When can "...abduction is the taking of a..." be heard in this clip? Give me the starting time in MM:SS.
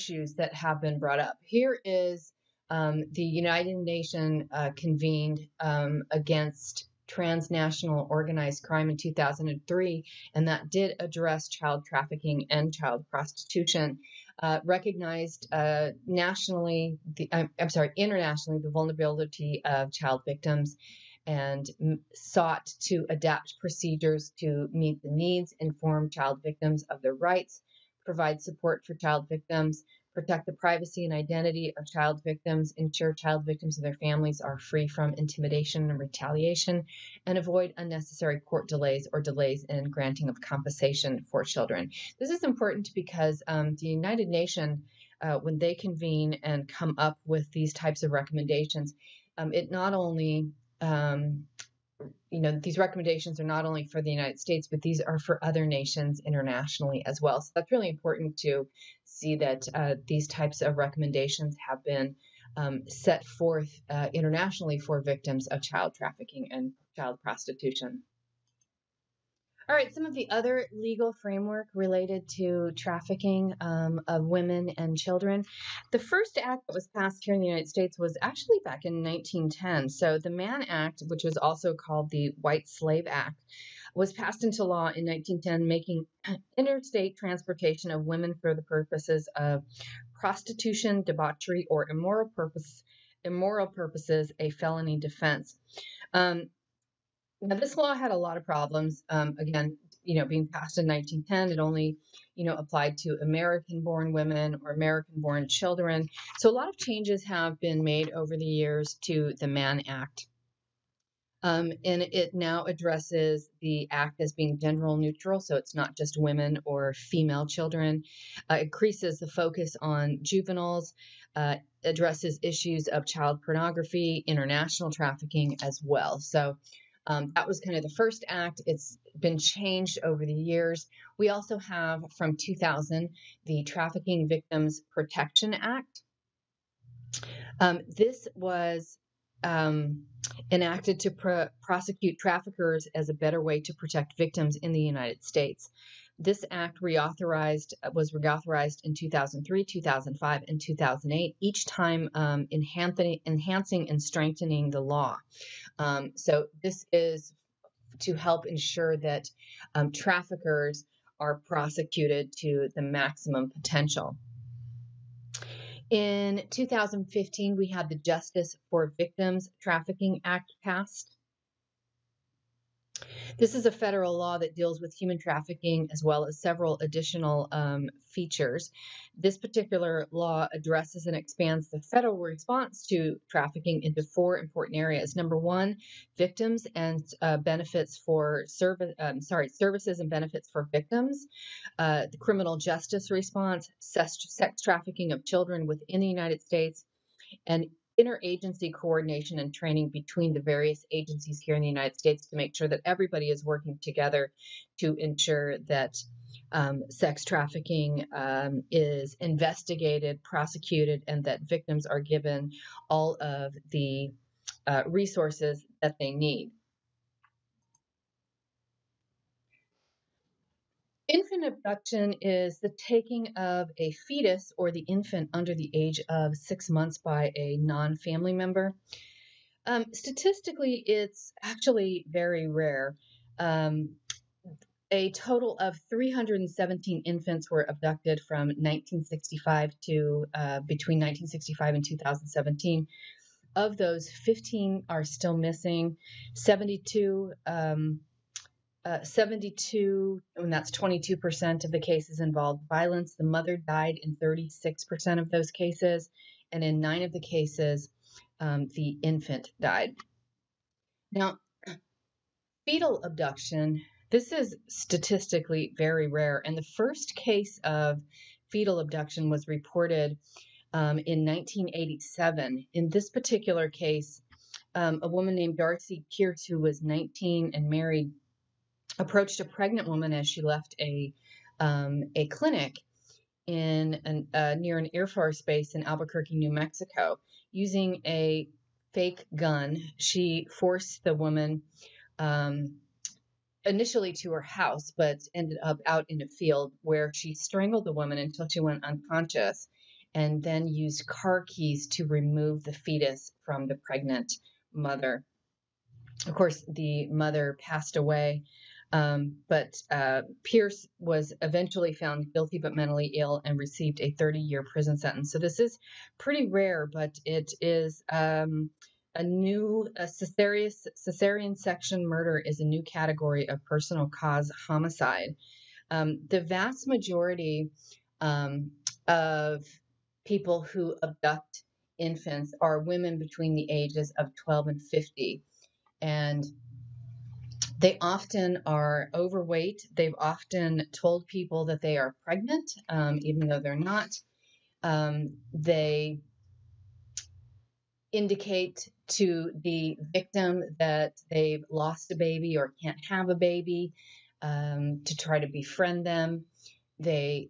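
03:41.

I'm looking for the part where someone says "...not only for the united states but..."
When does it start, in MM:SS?
00:53.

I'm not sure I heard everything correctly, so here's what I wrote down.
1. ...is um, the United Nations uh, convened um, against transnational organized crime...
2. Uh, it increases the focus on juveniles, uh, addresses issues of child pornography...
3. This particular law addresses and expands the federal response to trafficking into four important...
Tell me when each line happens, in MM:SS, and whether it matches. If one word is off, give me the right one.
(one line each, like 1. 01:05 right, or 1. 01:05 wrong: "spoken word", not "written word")
1. 00:01 right
2. 01:58 right
3. 02:59 right.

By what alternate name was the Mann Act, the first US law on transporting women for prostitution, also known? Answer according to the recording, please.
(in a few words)
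White Slave Act.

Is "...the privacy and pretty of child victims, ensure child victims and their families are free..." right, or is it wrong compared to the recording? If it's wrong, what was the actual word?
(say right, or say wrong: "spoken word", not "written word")
wrong: "identity", not "pretty".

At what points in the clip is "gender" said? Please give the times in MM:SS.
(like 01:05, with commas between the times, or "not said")
01:54.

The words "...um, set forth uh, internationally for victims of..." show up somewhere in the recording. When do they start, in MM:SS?
01:02.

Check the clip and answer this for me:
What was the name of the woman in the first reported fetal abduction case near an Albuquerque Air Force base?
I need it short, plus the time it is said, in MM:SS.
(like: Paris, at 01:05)
Darcy Pierce, at 04:35.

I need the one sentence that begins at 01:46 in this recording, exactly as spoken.
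So a lot of changes have been made over the years to the Mann Act.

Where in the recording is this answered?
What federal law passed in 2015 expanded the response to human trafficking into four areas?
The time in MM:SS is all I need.
02:47.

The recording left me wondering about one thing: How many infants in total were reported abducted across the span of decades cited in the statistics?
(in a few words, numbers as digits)
317.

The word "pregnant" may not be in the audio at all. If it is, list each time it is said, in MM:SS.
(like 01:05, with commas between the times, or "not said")
04:39, 05:03, 05:42.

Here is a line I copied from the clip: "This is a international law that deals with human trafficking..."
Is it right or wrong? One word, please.
wrong.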